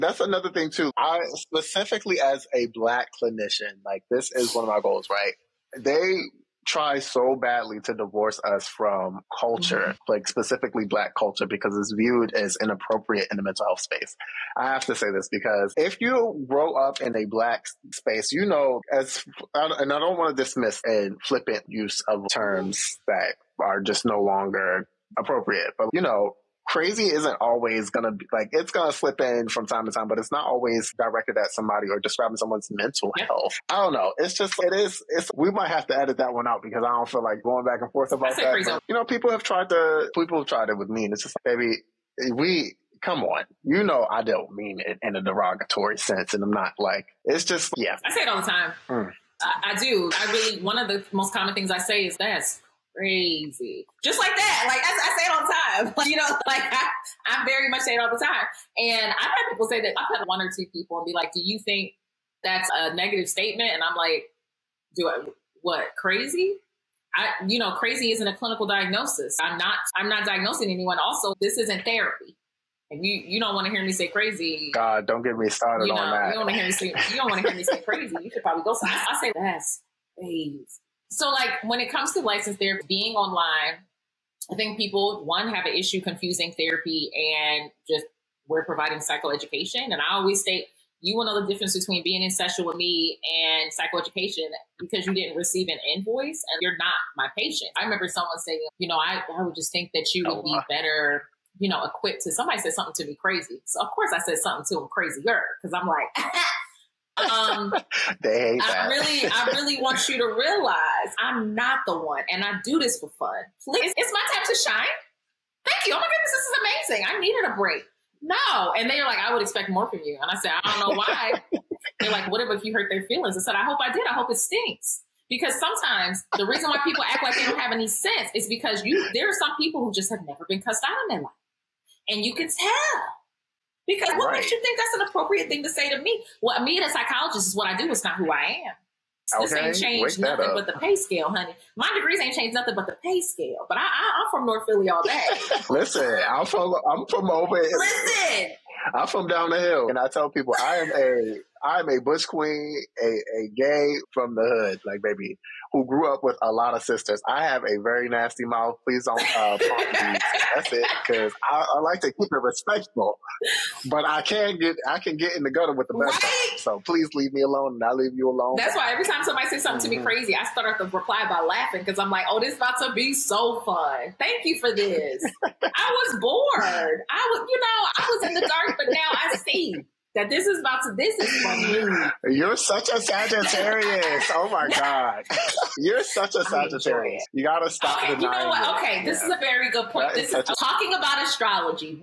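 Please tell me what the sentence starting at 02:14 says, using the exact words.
makes you think that's an appropriate thing to say to me?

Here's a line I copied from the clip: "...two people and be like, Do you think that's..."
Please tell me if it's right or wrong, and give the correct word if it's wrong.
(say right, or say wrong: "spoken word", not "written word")
right.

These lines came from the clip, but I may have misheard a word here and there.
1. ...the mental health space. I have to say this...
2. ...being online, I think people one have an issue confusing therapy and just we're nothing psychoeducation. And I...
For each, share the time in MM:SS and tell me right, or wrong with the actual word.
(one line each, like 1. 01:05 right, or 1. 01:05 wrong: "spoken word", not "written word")
1. 00:13 right
2. 01:22 wrong: "providing", not "nothing".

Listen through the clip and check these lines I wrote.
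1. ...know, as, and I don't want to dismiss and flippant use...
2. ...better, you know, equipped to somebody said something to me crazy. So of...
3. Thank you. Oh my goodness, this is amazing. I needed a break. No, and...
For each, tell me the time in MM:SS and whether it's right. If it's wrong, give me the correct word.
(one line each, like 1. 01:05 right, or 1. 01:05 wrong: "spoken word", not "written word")
1. 00:18 right
2. 01:40 right
3. 01:55 right.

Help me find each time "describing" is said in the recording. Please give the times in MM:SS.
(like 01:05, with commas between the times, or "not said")
00:31.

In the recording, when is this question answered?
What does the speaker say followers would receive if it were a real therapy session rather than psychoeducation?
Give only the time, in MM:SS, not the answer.
01:35.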